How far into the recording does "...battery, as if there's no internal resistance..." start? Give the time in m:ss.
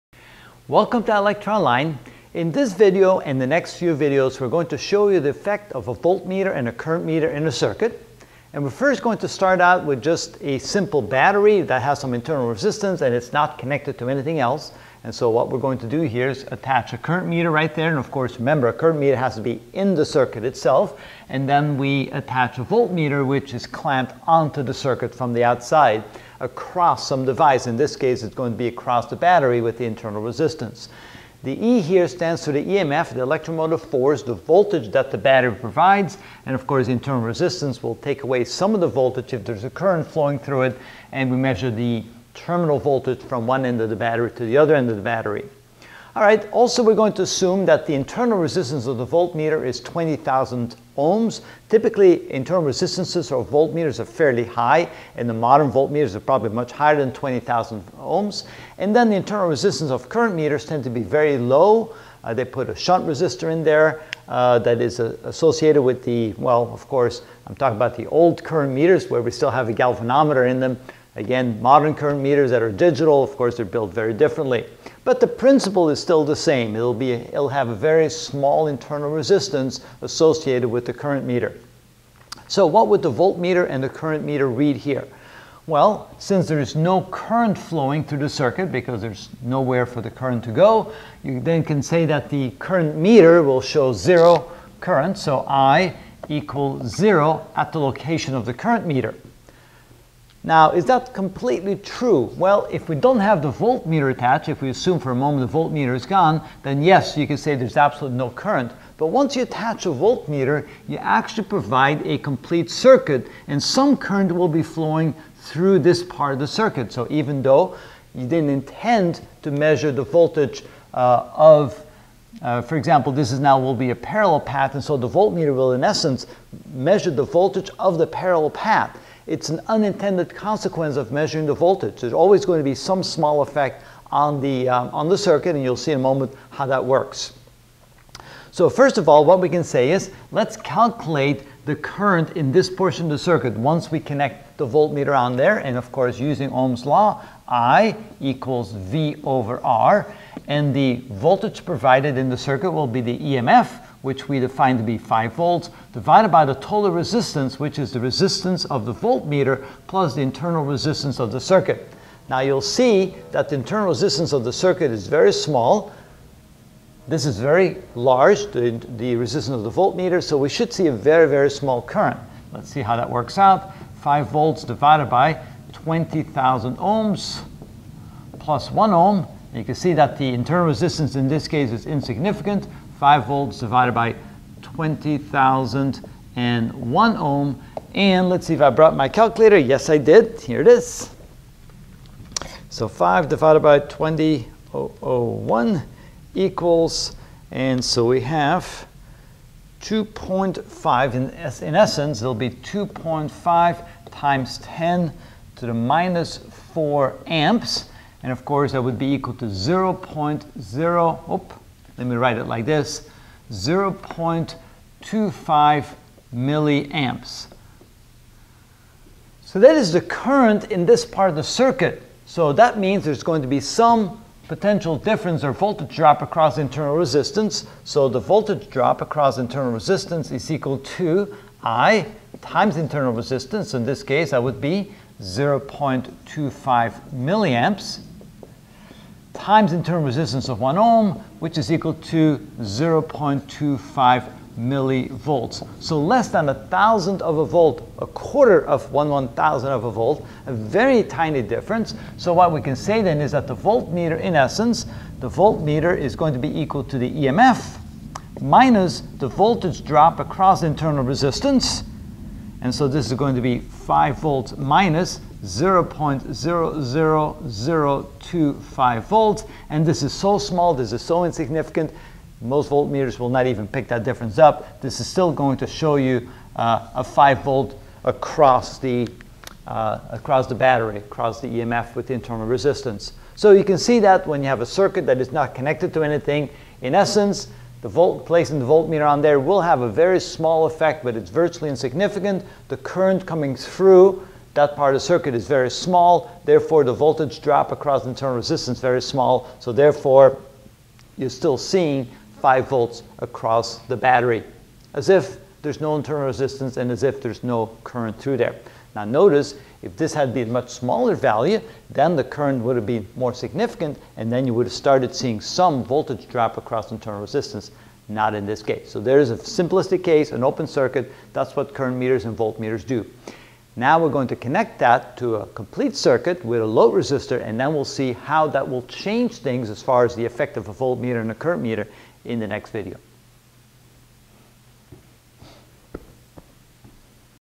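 5:03.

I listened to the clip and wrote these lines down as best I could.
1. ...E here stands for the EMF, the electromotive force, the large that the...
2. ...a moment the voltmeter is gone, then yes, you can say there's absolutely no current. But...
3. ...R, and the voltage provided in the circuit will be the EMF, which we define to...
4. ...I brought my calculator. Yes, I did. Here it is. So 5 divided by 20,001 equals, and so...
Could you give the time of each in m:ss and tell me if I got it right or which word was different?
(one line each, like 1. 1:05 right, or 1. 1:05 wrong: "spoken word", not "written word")
1. 0:31 wrong: "voltage", not "large"
2. 1:45 right
3. 2:29 right
4. 3:08 right.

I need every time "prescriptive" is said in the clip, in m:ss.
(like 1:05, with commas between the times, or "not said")
not said.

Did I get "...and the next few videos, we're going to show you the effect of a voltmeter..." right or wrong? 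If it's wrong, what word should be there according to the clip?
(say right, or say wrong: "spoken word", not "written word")
right.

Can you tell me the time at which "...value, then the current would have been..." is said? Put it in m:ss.
5:11.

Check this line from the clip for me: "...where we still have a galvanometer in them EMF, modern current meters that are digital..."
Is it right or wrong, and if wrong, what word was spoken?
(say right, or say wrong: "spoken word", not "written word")
wrong: "Again", not "EMF".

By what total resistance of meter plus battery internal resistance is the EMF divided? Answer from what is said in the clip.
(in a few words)
20,001 ohms.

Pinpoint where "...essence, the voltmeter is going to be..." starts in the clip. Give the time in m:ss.
4:14.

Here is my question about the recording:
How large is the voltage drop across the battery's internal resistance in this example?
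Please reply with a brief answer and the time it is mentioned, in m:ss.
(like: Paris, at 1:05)
0.25 millivolts, at 4:02.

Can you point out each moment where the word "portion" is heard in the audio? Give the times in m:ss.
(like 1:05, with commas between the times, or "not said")
2:22.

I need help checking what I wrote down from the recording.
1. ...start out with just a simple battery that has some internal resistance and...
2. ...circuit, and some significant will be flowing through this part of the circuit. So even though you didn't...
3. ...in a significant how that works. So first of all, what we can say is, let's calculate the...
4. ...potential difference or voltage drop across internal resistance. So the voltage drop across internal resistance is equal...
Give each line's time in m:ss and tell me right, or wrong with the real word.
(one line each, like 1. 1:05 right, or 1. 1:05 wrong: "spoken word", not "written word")
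1. 0:09 right
2. 1:52 wrong: "current", not "significant"
3. 2:15 wrong: "moment", not "significant"
4. 3:44 right.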